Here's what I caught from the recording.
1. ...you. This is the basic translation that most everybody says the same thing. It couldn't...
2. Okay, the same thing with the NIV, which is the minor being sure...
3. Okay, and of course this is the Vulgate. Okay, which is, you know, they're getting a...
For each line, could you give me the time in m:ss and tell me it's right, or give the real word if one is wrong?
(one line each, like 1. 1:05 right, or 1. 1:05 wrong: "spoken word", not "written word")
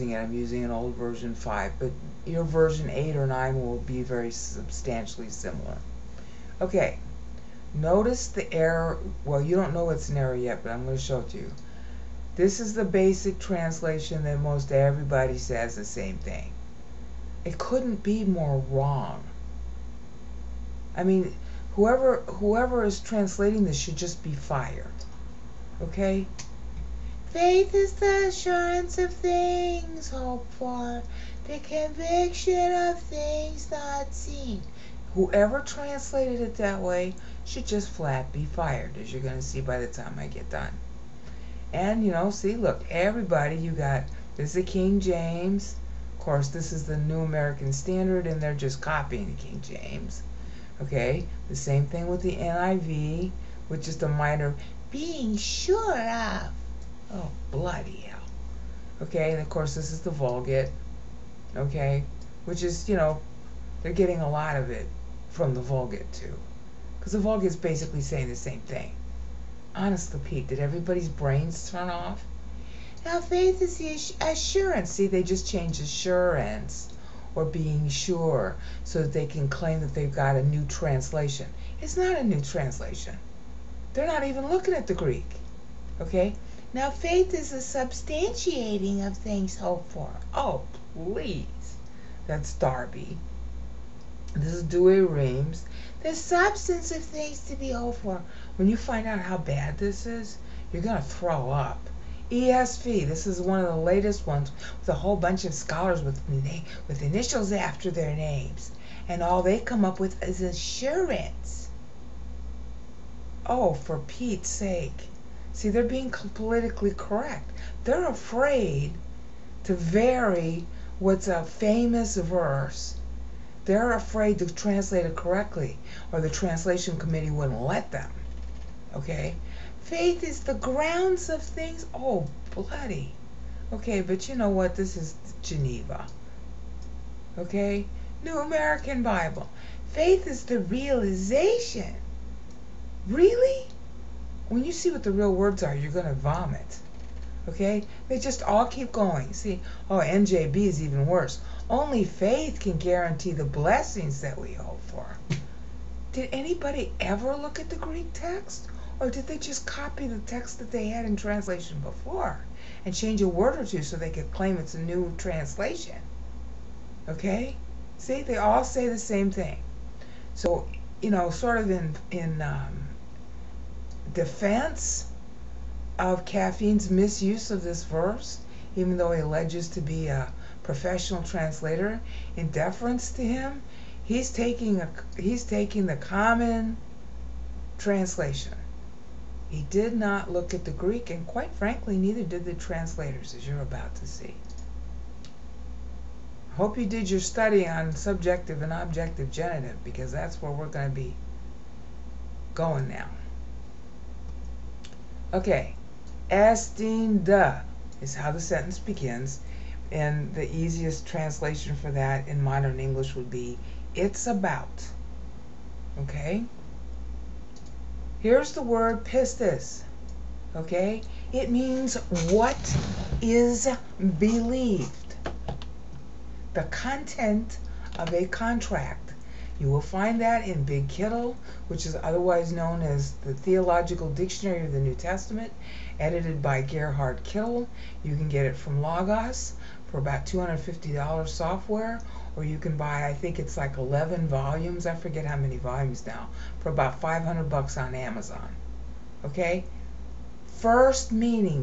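1. 0:11 right
2. 0:50 right
3. 0:59 right.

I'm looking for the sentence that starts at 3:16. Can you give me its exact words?
Hope you did your study on subjective and objective genitive, because that's where we're going to be going now.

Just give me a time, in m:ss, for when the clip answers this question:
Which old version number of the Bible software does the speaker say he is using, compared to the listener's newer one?
0:00.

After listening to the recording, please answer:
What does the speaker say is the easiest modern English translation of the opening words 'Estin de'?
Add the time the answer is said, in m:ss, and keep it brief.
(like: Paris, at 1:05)
it's about, at 3:33.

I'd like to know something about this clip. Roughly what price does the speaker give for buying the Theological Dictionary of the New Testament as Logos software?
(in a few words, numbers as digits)
$250.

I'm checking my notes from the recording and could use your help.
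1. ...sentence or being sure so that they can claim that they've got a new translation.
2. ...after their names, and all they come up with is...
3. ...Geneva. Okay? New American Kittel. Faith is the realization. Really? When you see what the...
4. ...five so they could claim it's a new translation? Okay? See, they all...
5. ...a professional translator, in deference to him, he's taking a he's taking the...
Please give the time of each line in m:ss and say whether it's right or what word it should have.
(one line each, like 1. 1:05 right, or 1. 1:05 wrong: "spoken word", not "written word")
1. 1:15 wrong: "assurance", not "sentence"
2. 1:47 right
3. 2:15 wrong: "Bible", not "Kittel"
4. 2:43 wrong: "two", not "five"
5. 3:00 right.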